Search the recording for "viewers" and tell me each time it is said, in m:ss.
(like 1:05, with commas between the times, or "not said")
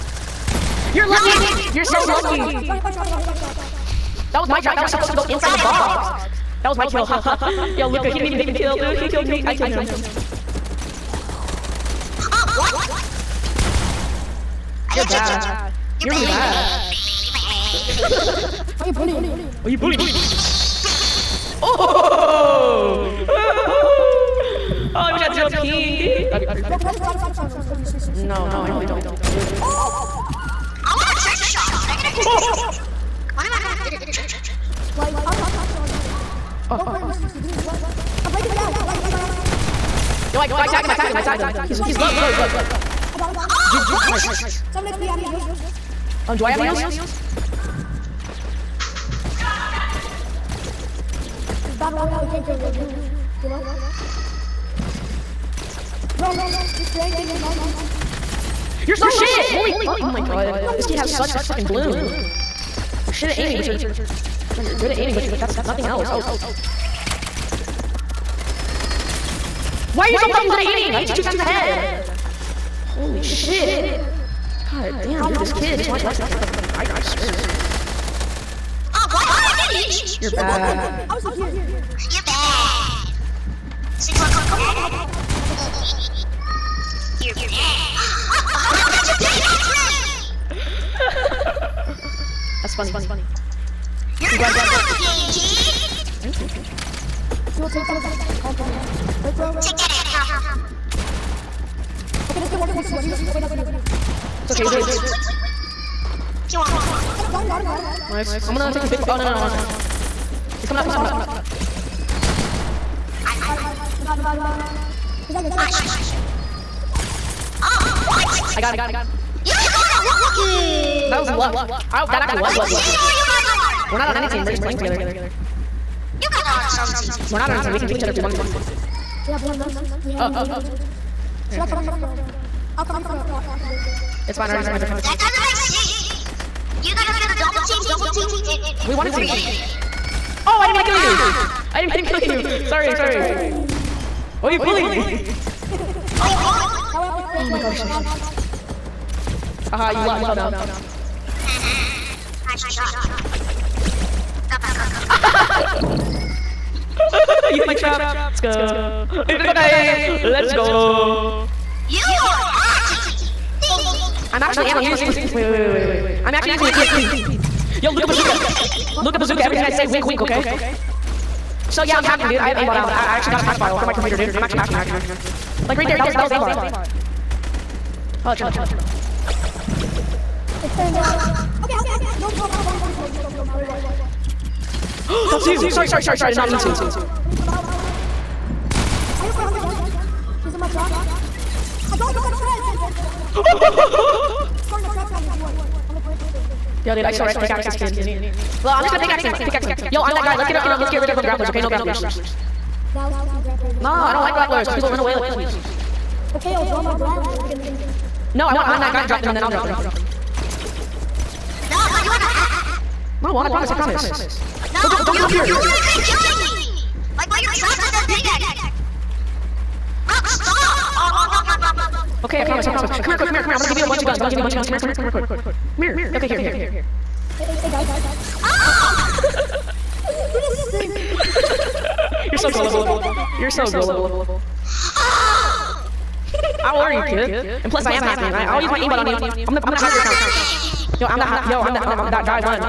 3:15.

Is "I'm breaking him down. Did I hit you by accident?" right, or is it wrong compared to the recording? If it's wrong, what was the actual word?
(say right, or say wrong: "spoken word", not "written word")
right.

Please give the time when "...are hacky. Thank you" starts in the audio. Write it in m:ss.
2:42.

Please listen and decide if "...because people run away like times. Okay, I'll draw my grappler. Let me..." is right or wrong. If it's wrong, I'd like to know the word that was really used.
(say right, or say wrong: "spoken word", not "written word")
wrong: "pussies", not "times".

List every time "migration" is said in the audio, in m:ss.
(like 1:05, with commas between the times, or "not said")
not said.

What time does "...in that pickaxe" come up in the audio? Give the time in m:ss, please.
3:37.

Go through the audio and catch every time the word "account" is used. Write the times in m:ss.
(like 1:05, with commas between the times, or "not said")
4:00.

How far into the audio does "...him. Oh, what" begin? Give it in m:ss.
0:43.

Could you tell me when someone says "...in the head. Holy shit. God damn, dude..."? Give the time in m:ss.
1:11.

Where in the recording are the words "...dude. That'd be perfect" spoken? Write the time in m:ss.
0:25.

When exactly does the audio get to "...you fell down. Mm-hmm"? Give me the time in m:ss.
2:30.